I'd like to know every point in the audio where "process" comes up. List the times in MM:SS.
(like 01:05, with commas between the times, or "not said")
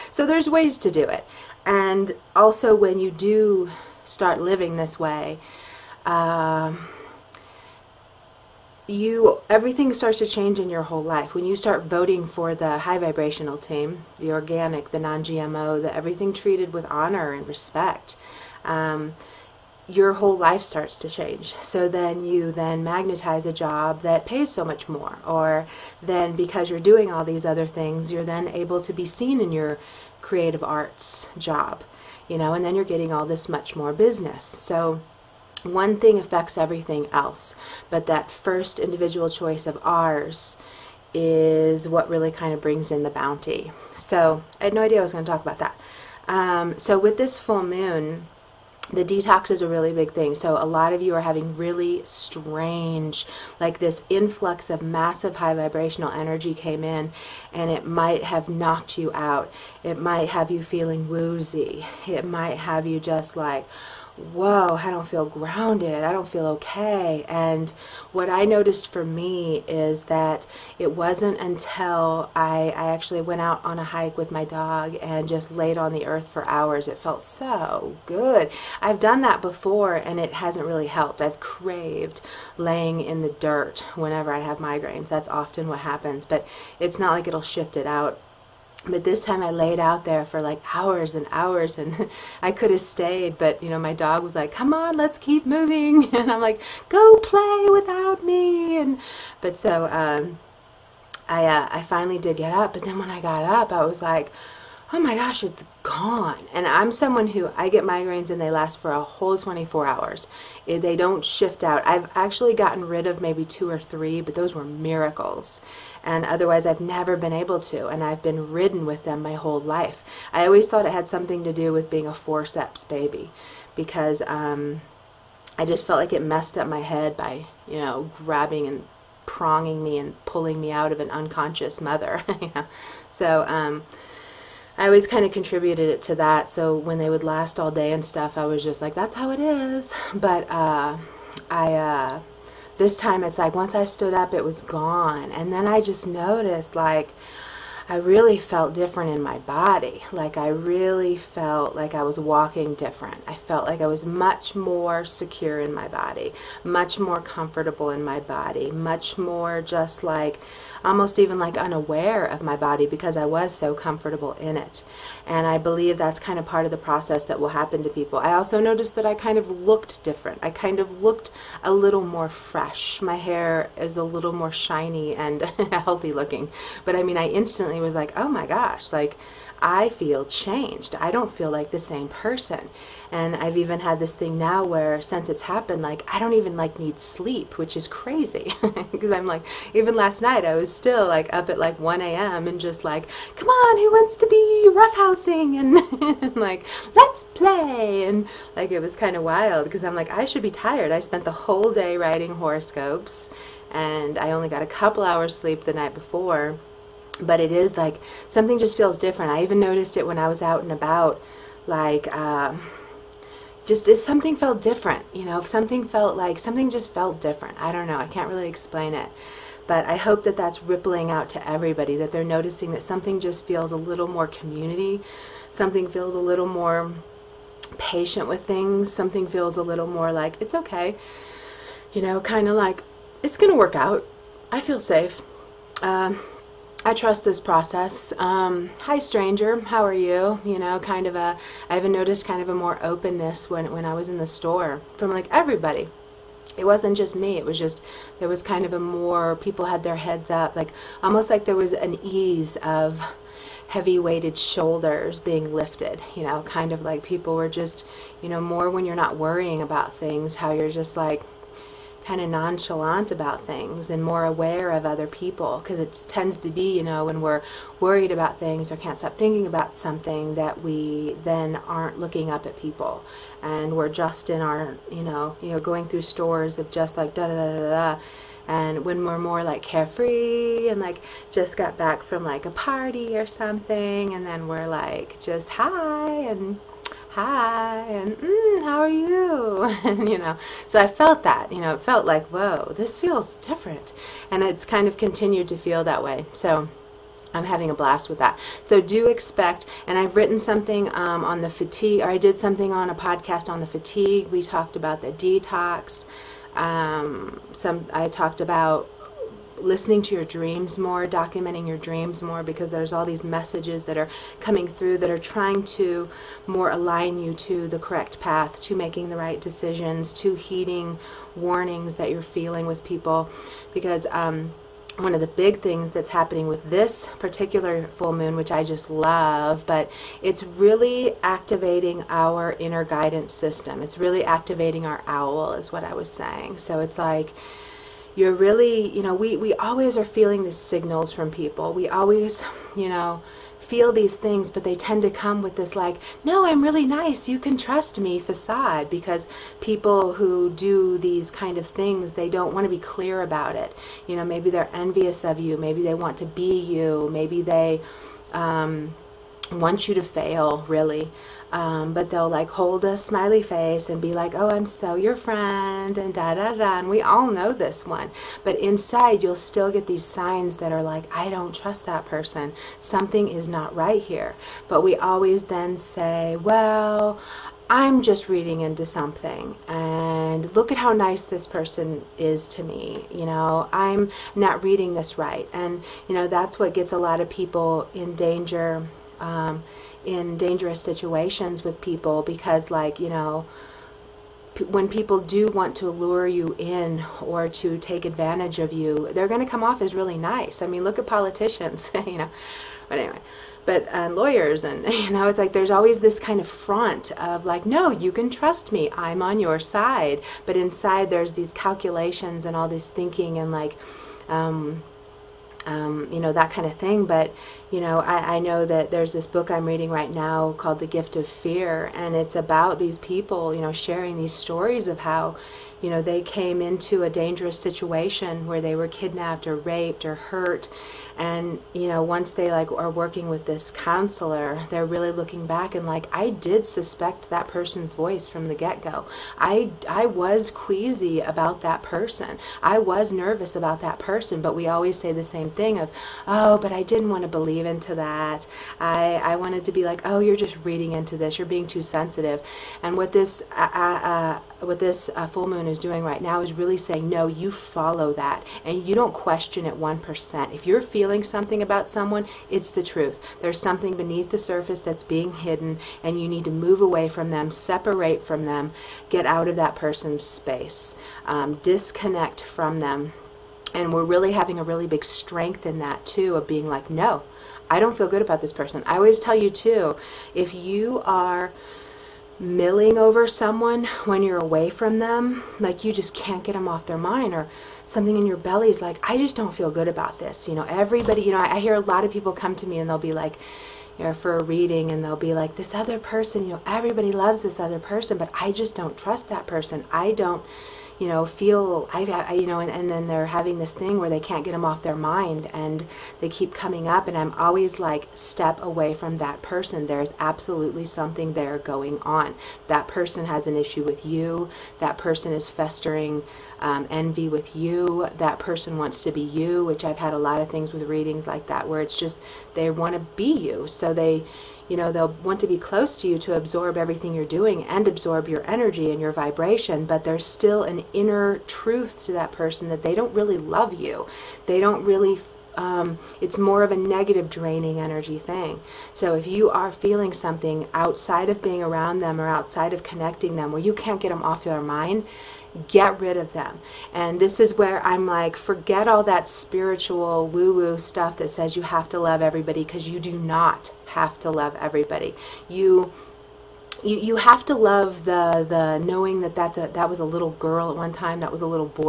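02:46, 03:57.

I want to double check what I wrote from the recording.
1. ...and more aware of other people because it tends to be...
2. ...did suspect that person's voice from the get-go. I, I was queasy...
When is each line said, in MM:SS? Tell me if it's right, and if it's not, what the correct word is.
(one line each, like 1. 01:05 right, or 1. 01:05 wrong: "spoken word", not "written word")
1. 04:23 right
2. 07:16 right.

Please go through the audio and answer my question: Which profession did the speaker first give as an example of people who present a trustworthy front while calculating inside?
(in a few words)
politicians.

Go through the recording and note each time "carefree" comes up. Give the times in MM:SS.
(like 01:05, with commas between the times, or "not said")
04:39.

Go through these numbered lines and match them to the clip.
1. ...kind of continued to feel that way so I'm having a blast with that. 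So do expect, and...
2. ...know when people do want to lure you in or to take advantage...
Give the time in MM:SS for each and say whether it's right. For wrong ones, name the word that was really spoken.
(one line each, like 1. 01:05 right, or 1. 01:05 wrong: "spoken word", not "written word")
1. 04:54 right
2. 06:33 right.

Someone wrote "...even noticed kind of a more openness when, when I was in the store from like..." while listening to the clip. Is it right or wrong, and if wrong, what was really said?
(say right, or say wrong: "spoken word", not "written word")
right.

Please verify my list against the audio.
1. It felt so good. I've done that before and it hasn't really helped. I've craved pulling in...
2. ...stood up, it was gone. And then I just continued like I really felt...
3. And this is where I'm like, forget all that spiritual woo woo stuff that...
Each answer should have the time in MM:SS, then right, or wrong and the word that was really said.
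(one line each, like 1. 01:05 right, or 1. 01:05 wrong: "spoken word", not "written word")
1. 01:16 wrong: "laying", not "pulling"
2. 02:23 wrong: "noticed", not "continued"
3. 09:06 right.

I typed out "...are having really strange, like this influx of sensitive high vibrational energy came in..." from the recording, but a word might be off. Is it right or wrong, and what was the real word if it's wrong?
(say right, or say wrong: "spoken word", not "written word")
wrong: "massive", not "sensitive".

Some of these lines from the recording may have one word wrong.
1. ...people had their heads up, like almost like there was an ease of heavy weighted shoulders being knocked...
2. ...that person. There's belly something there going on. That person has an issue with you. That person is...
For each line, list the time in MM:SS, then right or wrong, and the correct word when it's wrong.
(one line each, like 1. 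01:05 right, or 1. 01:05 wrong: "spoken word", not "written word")
1. 04:09 wrong: "lifted", not "knocked"
2. 08:29 wrong: "absolutely", not "belly".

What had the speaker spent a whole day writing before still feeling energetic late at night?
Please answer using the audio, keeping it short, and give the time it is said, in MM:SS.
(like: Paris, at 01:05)
horoscopes, at 03:22.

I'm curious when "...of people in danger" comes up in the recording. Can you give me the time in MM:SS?
06:27.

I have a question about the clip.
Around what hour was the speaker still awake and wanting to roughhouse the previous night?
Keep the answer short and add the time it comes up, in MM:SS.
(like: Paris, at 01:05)
1 a.m., at 03:11.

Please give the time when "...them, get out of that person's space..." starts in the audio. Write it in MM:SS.
07:48.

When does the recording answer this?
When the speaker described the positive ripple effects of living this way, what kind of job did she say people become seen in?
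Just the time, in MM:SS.
00:30.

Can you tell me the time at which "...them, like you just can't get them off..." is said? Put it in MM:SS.
08:04.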